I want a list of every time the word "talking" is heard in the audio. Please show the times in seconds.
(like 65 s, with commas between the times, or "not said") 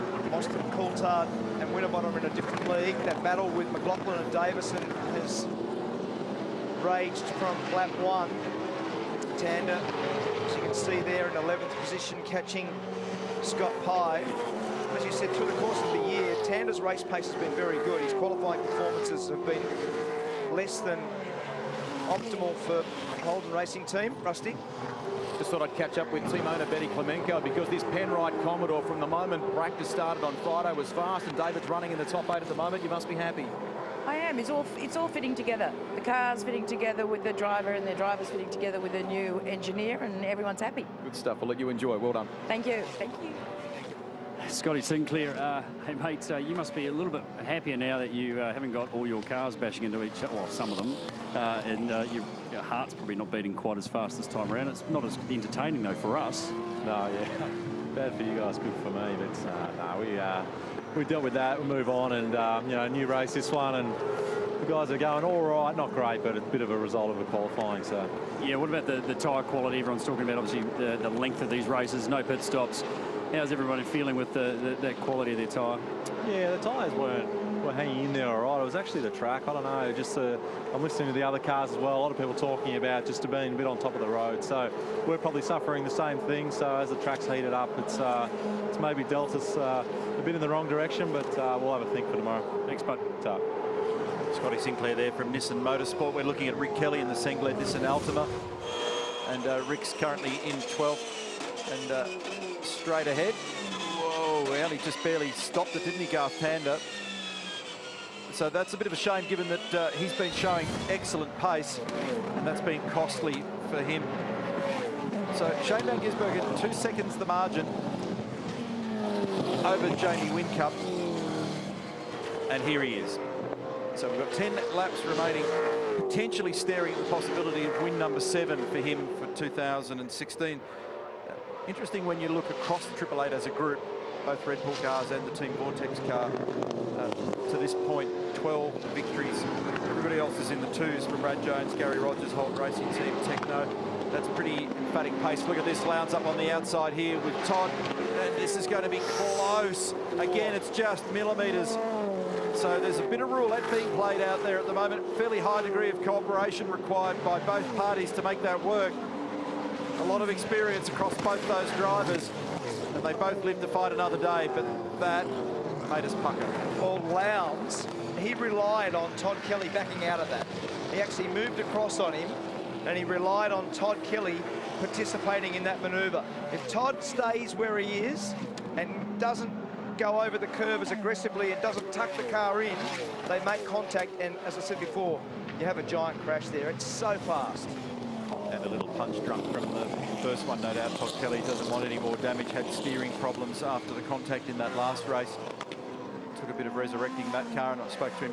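70 s, 82 s.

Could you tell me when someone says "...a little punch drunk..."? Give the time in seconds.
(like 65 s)
188 s.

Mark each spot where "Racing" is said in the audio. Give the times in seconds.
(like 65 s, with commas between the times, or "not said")
23 s, 142 s.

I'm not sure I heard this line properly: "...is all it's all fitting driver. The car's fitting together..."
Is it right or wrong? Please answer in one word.
wrong.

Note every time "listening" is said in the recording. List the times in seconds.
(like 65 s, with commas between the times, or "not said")
80 s.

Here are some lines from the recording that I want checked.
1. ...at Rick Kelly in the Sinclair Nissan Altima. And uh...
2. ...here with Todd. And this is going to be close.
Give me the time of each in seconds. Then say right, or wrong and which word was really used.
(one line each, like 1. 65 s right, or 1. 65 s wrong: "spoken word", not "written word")
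1. 96 s right
2. 146 s right.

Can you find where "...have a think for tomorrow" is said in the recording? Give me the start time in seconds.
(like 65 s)
91 s.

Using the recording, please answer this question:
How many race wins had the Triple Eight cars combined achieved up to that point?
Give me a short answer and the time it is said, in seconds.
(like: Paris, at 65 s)
12, at 138 s.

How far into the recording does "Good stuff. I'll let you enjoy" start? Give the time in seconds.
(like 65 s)
41 s.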